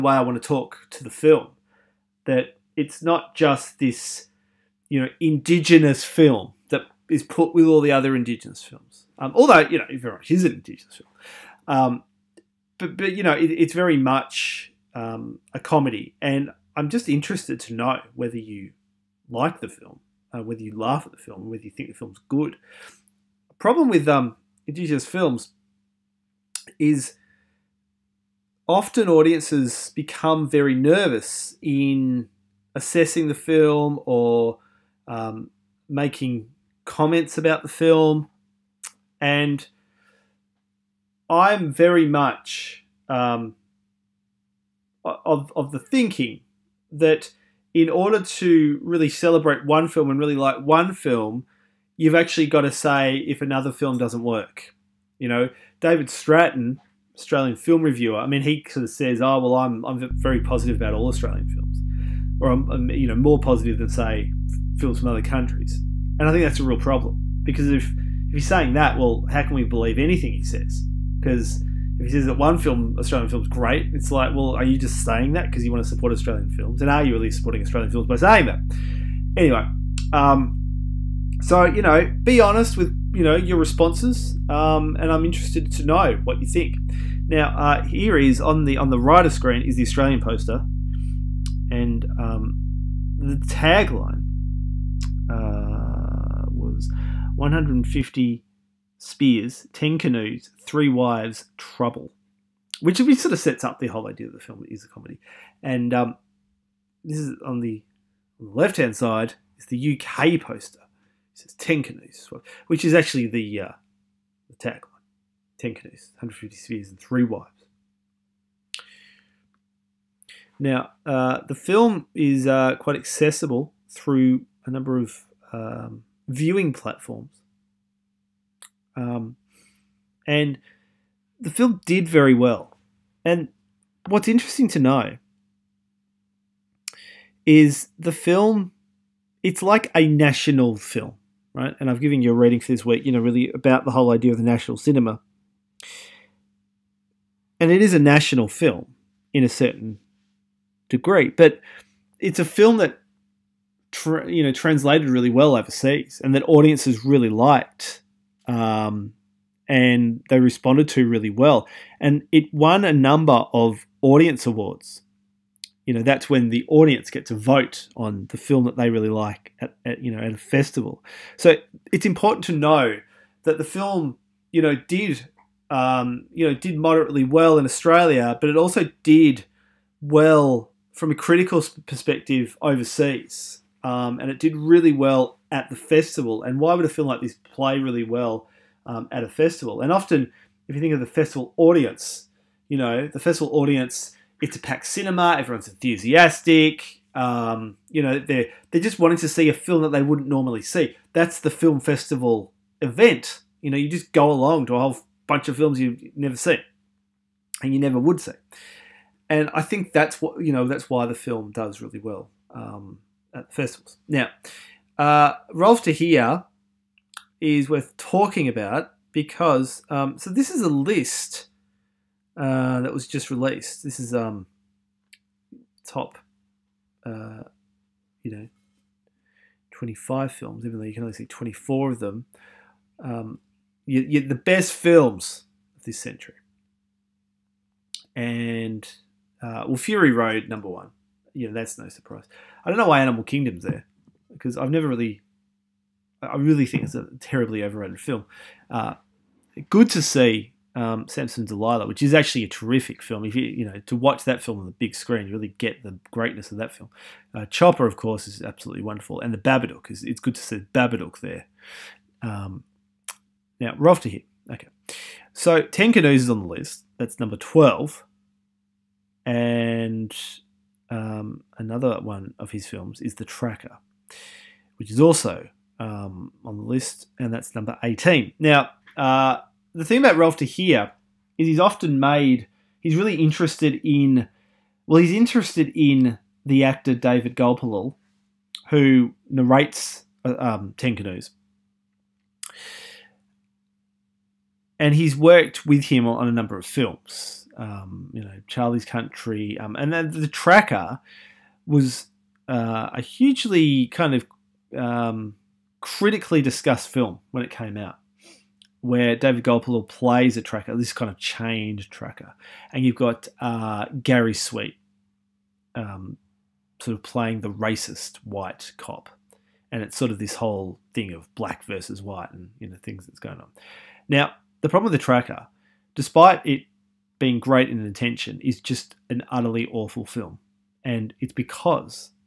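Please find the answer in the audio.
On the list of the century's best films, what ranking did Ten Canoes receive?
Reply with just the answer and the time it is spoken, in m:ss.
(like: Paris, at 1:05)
12, at 4:27.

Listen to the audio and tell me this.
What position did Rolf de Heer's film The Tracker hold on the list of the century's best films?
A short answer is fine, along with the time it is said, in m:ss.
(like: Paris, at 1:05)
18, at 4:37.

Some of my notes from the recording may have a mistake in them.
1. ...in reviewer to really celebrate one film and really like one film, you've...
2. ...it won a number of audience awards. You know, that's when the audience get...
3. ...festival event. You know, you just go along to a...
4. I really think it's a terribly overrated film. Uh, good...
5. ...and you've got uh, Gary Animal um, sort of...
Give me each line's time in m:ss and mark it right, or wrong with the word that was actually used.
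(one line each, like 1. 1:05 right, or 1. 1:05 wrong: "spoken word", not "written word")
1. 0:47 wrong: "order", not "reviewer"
2. 2:42 right
3. 3:21 right
4. 4:06 right
5. 5:12 wrong: "Sweet", not "Animal".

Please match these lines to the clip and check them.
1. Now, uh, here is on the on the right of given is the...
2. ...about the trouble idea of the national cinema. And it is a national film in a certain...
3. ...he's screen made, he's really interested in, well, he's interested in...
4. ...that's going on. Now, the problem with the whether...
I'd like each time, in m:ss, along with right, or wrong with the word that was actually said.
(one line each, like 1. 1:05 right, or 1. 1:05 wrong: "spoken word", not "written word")
1. 1:27 wrong: "screen", not "given"
2. 2:23 wrong: "whole", not "trouble"
3. 4:41 wrong: "often", not "screen"
4. 5:23 wrong: "tracker", not "whether".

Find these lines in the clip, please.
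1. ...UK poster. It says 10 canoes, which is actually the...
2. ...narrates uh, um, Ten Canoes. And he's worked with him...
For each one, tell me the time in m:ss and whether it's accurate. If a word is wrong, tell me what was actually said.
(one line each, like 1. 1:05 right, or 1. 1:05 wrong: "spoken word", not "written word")
1. 1:49 right
2. 4:49 right.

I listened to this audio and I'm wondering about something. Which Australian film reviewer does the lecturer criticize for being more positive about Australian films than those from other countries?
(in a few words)
David Stratton.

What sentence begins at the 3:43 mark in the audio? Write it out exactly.
This is um, top, uh, you know, twenty five films.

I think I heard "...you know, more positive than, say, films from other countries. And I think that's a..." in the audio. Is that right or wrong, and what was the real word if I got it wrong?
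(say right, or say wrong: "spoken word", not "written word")
right.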